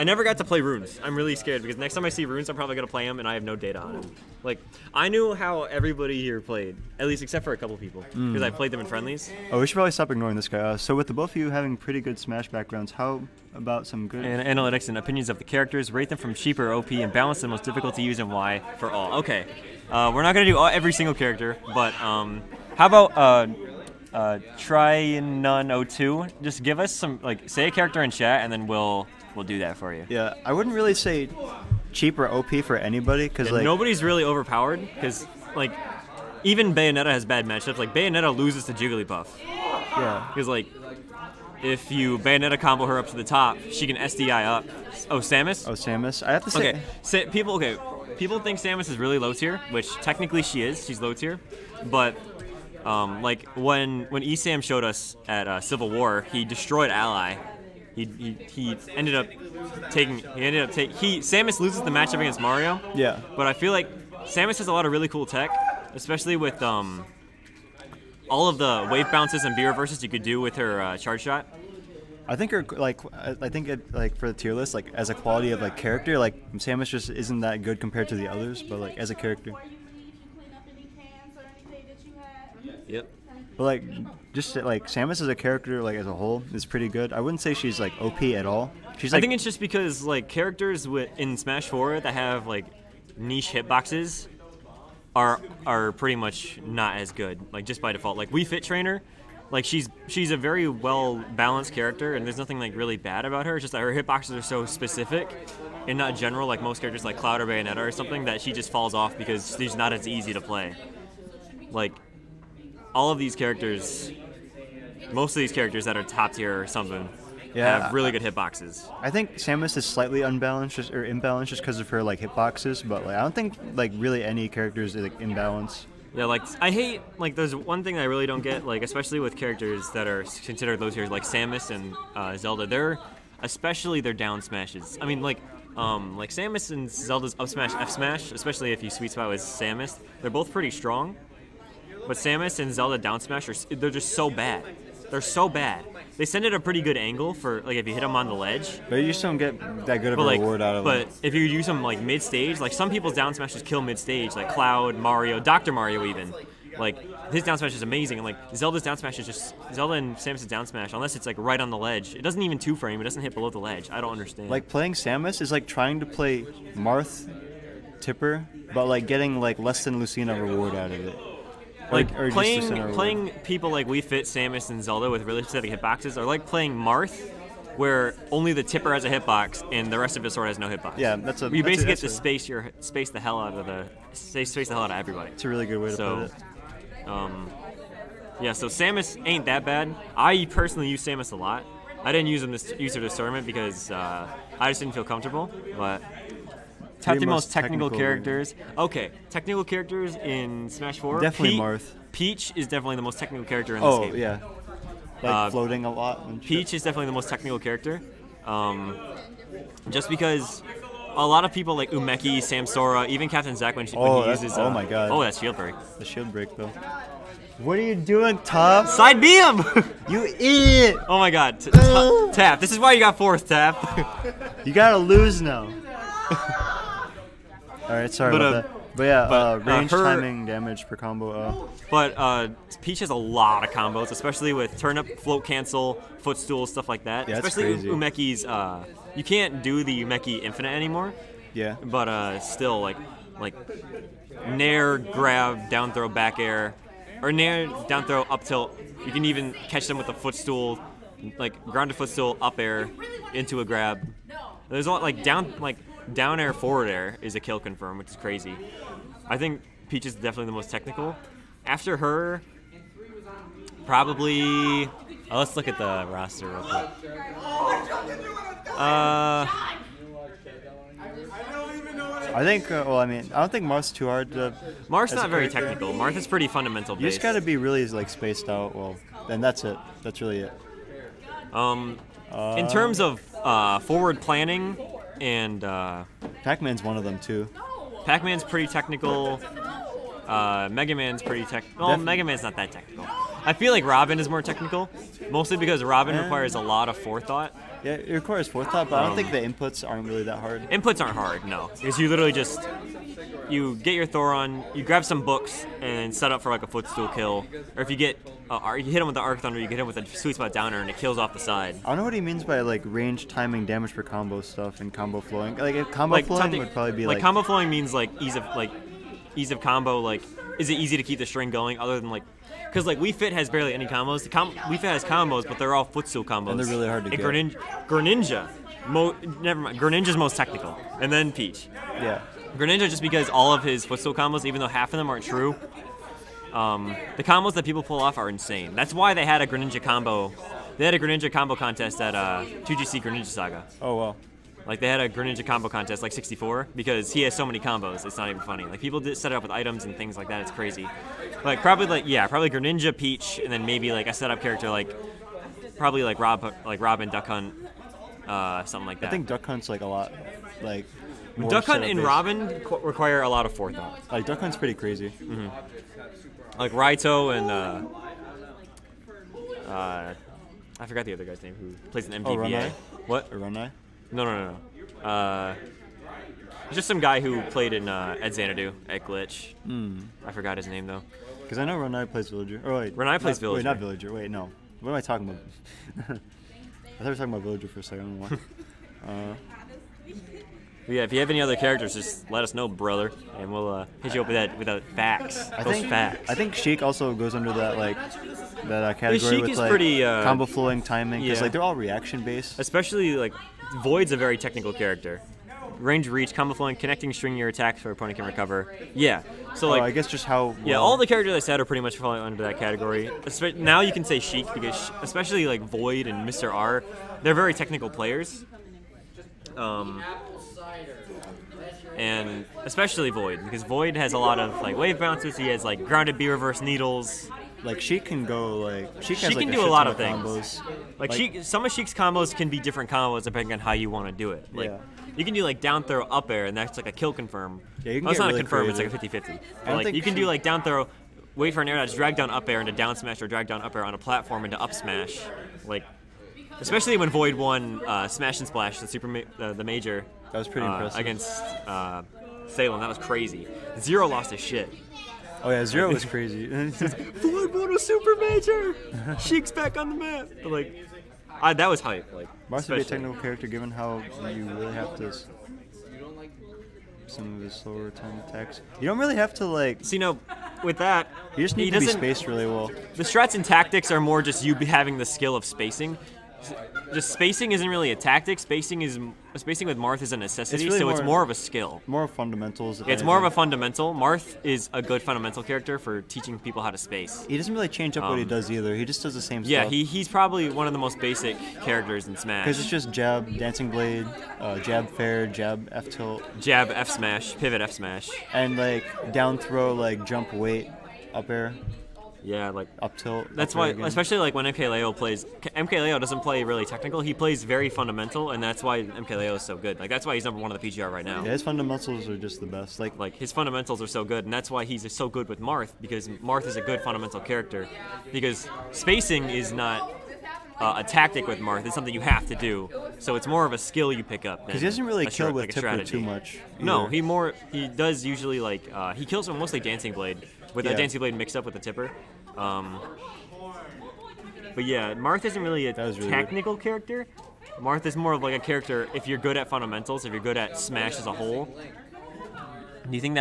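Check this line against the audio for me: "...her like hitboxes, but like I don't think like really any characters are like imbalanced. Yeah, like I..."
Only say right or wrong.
right.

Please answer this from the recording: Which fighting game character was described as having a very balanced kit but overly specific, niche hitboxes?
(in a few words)
Wii Fit Trainer.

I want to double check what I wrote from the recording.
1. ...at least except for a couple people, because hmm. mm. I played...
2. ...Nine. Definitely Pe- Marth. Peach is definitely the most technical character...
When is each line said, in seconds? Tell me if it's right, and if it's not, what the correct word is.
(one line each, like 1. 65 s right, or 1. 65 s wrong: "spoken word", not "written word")
1. 6 s right
2. 200 s wrong: "Four", not "Nine".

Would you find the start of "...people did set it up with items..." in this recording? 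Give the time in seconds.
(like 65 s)
348 s.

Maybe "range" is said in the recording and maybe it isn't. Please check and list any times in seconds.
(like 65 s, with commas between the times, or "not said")
229 s, 312 s, 405 s.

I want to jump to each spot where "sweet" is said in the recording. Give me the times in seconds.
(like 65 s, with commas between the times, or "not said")
138 s, 310 s.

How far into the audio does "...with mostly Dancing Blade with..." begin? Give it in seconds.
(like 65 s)
529 s.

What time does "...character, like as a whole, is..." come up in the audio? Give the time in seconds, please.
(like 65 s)
85 s.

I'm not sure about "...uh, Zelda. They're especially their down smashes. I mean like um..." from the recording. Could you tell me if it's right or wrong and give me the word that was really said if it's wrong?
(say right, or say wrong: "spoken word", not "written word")
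right.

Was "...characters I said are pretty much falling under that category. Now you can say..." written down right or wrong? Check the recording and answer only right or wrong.
right.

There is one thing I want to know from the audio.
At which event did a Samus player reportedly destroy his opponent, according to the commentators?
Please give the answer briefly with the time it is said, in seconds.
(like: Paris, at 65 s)
Civil War, at 55 s.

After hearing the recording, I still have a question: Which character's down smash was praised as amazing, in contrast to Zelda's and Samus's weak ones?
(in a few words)
Doctor Mario.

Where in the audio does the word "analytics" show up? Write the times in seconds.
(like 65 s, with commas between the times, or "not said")
14 s.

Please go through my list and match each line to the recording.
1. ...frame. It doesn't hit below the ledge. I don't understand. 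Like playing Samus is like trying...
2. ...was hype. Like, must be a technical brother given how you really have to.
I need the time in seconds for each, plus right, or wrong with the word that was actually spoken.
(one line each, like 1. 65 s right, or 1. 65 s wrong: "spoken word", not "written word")
1. 162 s right
2. 461 s wrong: "character", not "brother".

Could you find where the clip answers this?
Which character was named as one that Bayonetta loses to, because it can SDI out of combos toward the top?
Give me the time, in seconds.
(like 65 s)
38 s.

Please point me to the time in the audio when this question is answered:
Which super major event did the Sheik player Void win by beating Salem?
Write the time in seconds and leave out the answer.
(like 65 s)
448 s.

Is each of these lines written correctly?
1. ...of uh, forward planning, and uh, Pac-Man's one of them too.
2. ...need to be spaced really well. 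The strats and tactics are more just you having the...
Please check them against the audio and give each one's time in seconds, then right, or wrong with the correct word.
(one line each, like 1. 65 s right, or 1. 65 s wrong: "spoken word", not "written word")
1. 282 s right
2. 471 s right.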